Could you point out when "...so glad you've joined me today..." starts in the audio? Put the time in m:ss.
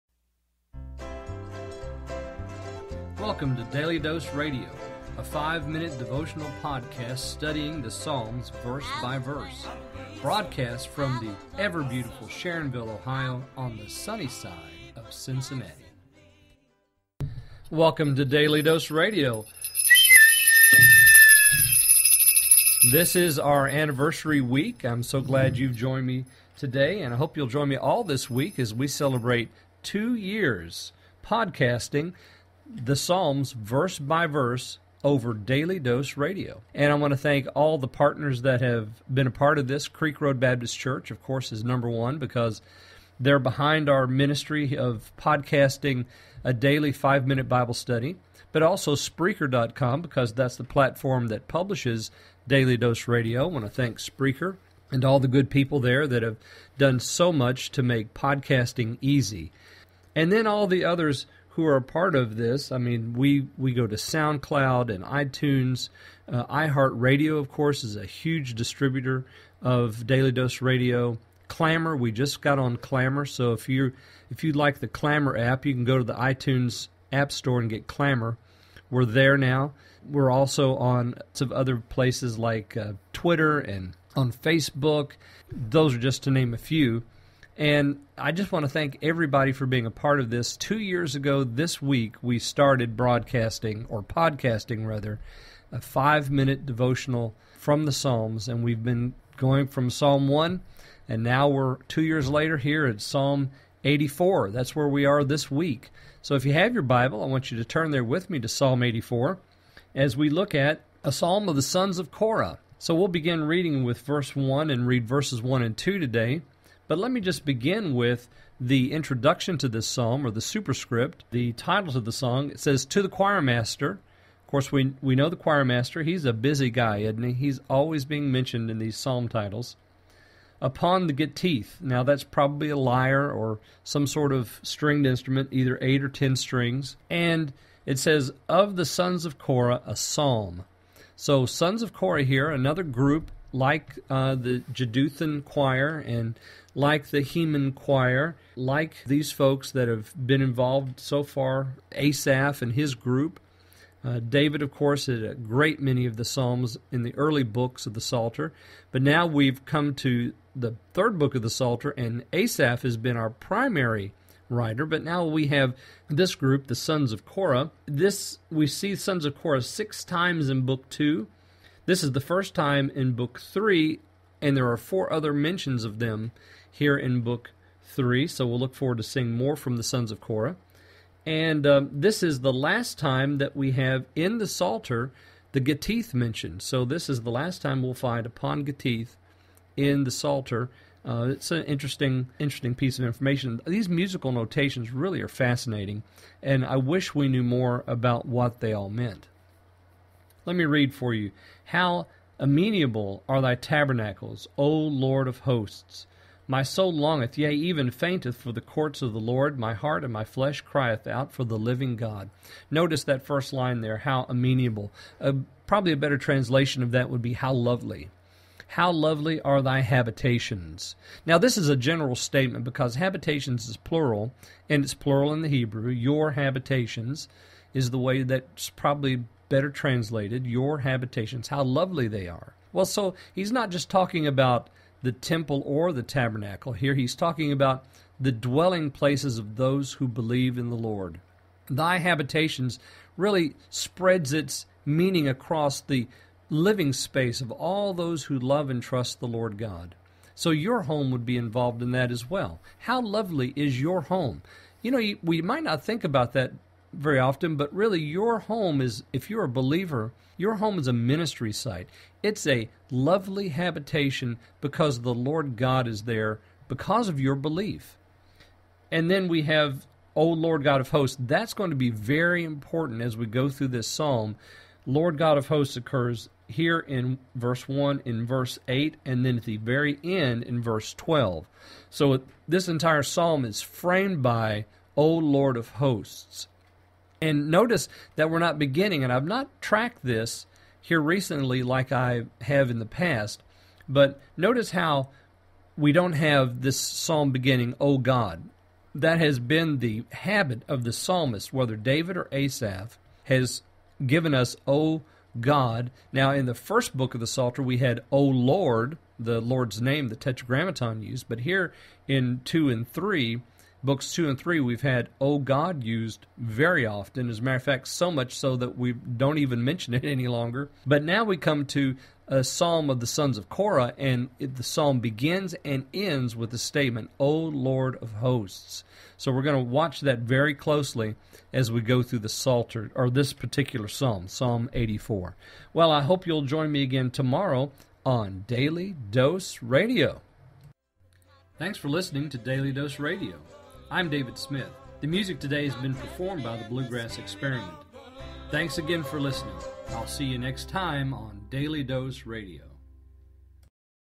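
0:25.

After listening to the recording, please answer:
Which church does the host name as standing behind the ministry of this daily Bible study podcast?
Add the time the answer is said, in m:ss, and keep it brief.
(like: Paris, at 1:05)
Creek Road Baptist Church, at 0:39.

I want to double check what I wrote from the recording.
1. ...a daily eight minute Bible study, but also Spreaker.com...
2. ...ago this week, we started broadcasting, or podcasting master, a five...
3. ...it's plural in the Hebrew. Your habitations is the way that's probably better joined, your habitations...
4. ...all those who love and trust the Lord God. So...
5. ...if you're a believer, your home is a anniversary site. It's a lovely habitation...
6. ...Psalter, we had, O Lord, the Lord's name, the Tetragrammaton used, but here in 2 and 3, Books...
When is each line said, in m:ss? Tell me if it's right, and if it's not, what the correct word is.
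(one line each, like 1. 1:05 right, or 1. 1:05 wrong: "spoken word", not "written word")
1. 0:46 wrong: "five", not "eight"
2. 1:31 wrong: "rather", not "master"
3. 3:44 wrong: "translated", not "joined"
4. 4:07 right
5. 4:19 wrong: "ministry", not "anniversary"
6. 5:07 right.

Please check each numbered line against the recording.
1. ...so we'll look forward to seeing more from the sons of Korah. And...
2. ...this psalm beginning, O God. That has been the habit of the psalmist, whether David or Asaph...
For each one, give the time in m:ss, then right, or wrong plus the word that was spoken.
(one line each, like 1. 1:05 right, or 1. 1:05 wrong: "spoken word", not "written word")
1. 2:58 right
2. 4:56 right.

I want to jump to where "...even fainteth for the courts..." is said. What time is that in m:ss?
3:27.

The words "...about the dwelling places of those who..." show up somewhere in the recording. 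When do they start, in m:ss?
3:57.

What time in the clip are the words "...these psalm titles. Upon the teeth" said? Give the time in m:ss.
2:08.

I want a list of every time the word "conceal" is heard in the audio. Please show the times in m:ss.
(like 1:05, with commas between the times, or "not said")
not said.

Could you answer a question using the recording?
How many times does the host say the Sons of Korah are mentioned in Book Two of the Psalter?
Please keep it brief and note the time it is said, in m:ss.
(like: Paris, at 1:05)
6, at 2:49.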